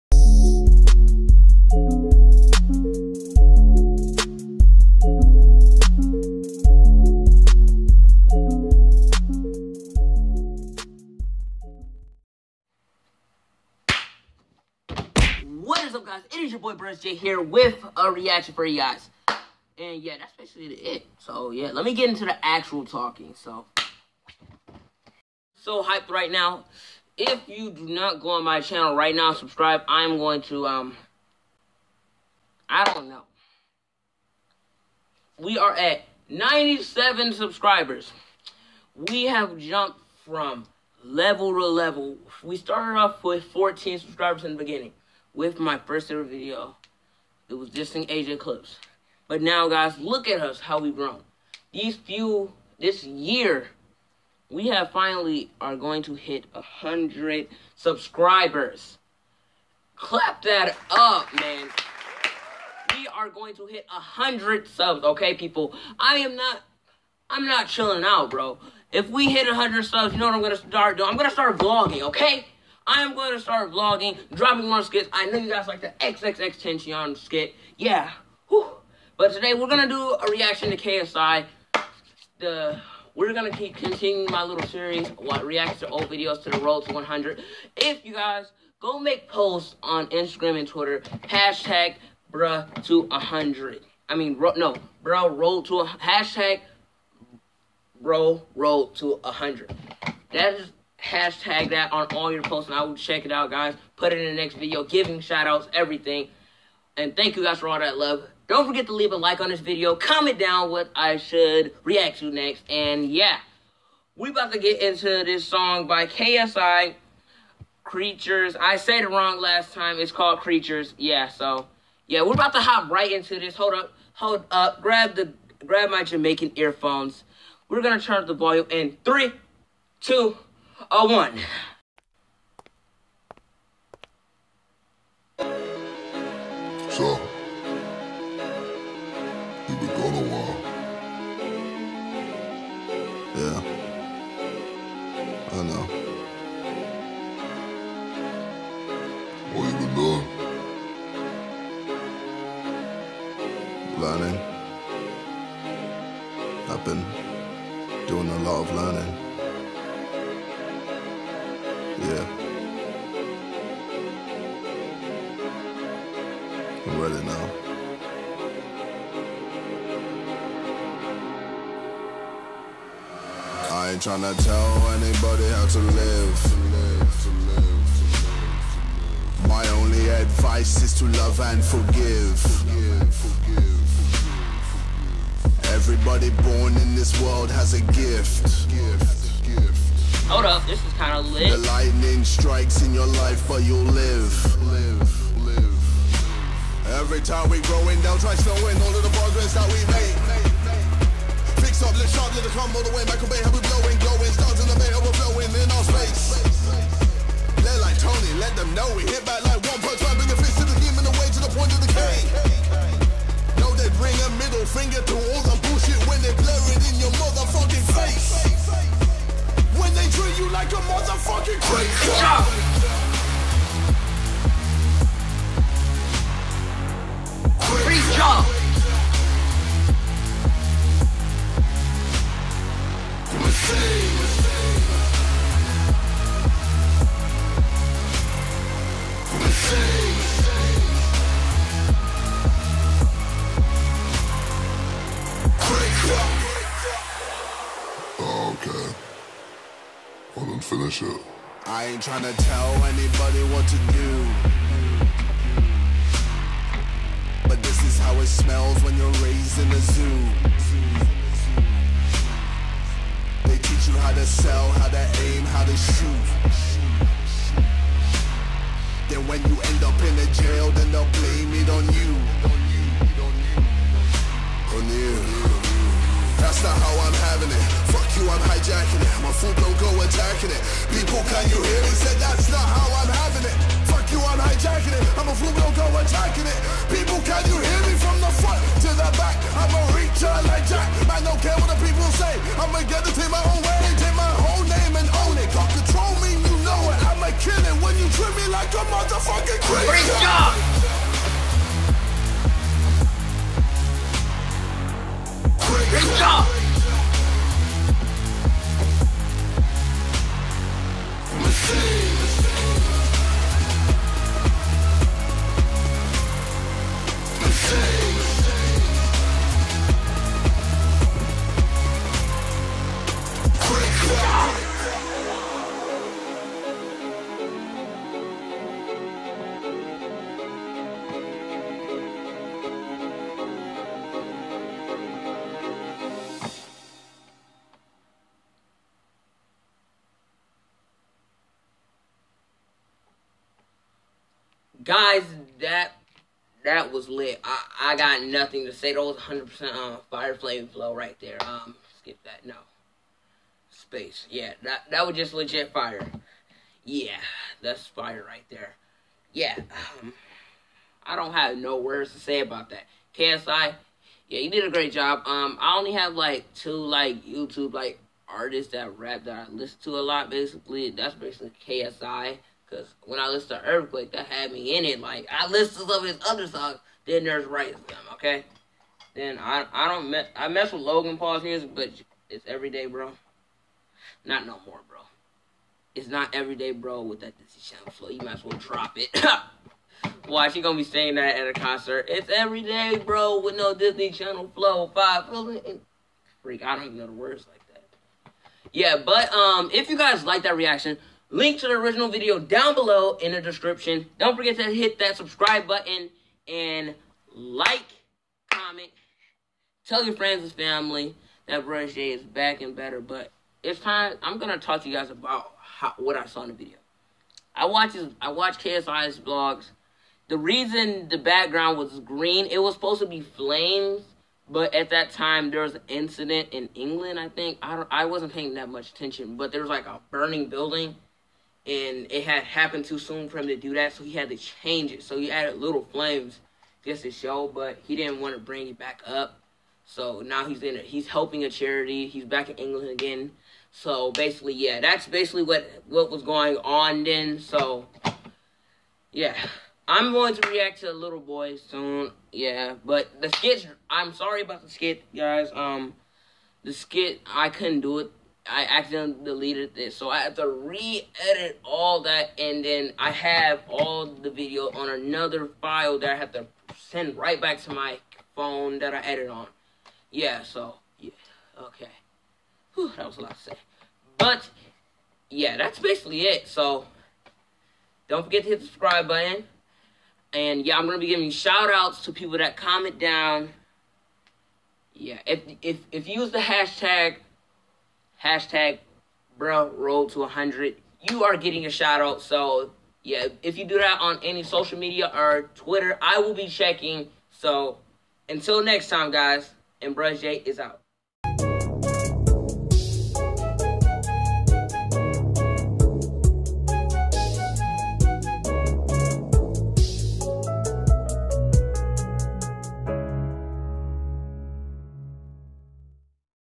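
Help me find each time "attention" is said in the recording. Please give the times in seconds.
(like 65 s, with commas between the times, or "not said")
428 s.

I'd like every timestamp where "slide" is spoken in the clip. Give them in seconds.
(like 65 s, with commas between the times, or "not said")
not said.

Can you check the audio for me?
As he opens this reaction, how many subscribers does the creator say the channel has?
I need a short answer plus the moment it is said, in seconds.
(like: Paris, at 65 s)
97, at 36 s.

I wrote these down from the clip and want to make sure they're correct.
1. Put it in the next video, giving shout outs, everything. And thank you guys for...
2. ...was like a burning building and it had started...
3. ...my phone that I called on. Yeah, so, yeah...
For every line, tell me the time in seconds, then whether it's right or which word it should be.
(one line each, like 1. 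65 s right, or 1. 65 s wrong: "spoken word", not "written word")
1. 103 s right
2. 429 s wrong: "happened", not "started"
3. 467 s wrong: "edited", not "called".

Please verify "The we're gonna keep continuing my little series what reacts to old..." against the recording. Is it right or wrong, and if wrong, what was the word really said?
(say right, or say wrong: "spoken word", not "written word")
right.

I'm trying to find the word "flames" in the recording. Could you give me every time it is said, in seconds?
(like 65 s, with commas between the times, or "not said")
350 s, 423 s, 435 s.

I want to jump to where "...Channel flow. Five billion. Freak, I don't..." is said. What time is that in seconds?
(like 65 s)
394 s.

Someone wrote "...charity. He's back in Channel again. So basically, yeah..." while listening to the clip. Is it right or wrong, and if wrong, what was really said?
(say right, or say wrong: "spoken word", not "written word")
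wrong: "England", not "Channel".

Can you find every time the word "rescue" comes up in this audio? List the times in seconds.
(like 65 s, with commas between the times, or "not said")
not said.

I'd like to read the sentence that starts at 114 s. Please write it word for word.
We about to get into this song by KSI, Creatures.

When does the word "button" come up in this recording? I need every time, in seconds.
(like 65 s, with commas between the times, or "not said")
405 s, 479 s.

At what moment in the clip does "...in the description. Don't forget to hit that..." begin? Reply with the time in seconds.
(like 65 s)
403 s.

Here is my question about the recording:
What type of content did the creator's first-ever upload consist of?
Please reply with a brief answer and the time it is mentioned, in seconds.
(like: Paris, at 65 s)
Asia clips, at 48 s.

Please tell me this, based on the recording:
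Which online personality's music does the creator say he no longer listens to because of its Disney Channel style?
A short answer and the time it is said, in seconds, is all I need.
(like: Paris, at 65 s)
Logan Paul, at 380 s.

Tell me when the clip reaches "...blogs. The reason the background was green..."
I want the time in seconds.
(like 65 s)
419 s.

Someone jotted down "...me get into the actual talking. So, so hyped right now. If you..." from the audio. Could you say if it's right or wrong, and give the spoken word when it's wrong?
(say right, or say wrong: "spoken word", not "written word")
right.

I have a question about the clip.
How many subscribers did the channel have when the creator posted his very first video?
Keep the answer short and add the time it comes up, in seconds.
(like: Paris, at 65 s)
14, at 43 s.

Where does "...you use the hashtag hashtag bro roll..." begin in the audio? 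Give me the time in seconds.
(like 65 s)
486 s.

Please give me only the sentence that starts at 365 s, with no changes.
Um, I only have like two like YouTube like artists that rap that I listen to a lot.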